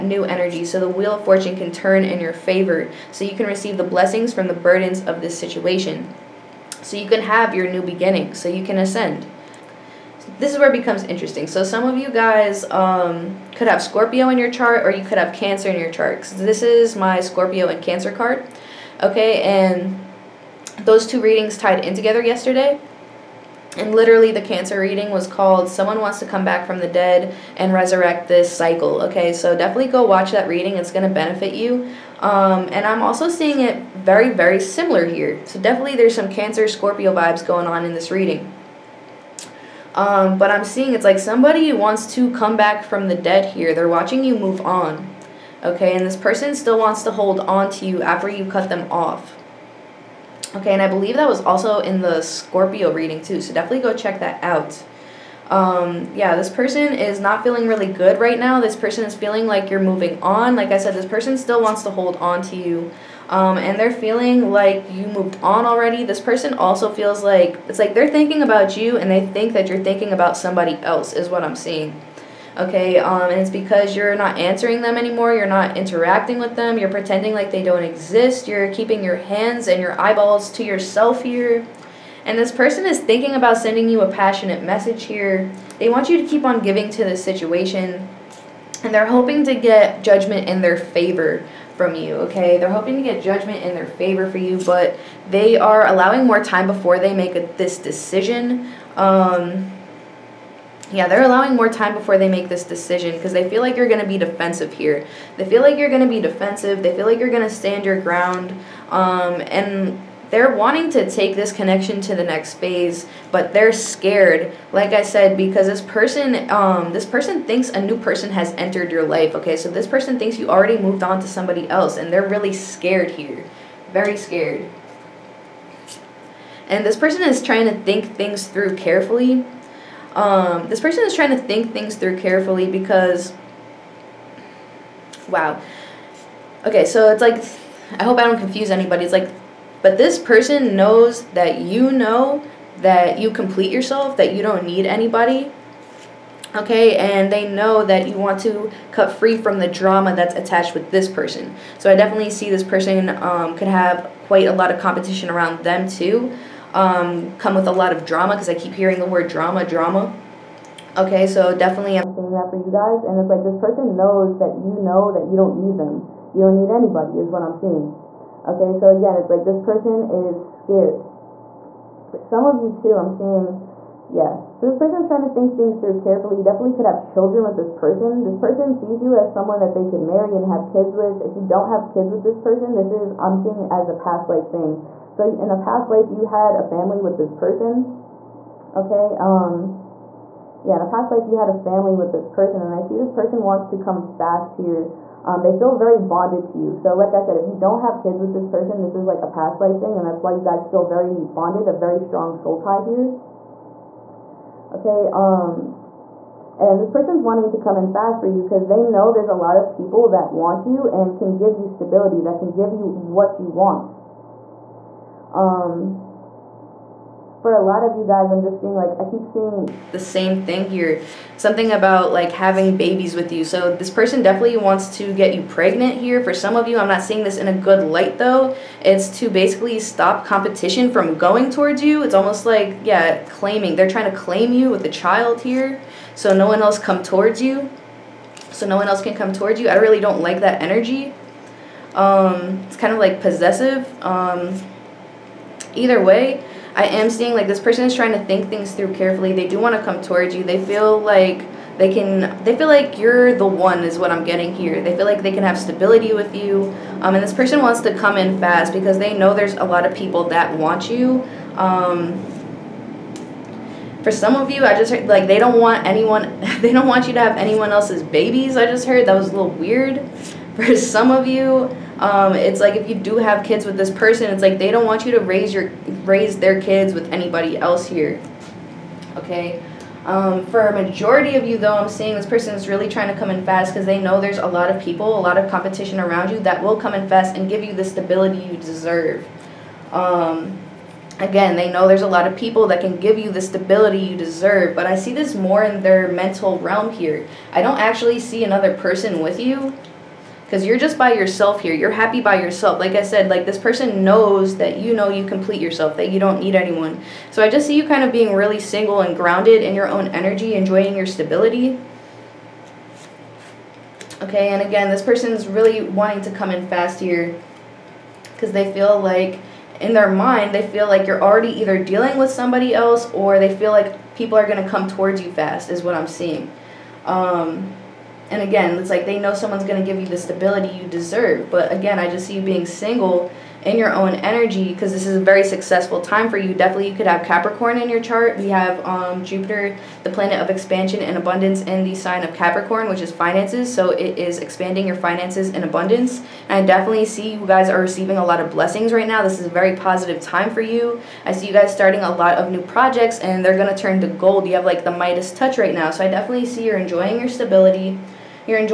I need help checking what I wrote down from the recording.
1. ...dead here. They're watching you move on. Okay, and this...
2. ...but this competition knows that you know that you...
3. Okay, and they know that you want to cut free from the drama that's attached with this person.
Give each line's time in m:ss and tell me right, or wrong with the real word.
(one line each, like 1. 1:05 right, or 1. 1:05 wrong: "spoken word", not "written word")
1. 0:43 right
2. 2:19 wrong: "person", not "competition"
3. 2:26 right.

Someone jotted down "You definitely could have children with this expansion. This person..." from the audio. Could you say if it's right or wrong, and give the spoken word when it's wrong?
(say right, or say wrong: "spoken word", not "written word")
wrong: "person", not "expansion".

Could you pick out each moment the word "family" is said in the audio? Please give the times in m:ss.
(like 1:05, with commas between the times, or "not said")
3:06, 3:11.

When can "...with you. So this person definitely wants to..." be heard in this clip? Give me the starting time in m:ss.
3:43.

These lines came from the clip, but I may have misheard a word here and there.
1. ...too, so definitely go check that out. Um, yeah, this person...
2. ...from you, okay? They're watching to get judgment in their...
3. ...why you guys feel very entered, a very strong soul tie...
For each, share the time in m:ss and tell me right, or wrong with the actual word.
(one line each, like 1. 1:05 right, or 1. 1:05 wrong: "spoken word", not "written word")
1. 0:53 right
2. 1:31 wrong: "hoping", not "watching"
3. 3:20 wrong: "bonded", not "entered".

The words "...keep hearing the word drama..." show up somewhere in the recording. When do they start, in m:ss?
2:38.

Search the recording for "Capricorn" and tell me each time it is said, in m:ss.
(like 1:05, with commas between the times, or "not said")
5:37, 5:42.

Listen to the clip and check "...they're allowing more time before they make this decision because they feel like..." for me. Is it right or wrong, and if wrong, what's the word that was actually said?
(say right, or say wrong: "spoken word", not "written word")
right.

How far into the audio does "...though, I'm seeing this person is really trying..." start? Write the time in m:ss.
4:41.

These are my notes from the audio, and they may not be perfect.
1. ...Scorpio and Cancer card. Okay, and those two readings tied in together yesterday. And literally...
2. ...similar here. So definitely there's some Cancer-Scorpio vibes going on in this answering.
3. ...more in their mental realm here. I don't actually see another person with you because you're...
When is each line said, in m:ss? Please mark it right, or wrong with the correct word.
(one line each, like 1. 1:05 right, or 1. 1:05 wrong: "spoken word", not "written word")
1. 0:17 right
2. 0:34 wrong: "reading", not "answering"
3. 4:55 right.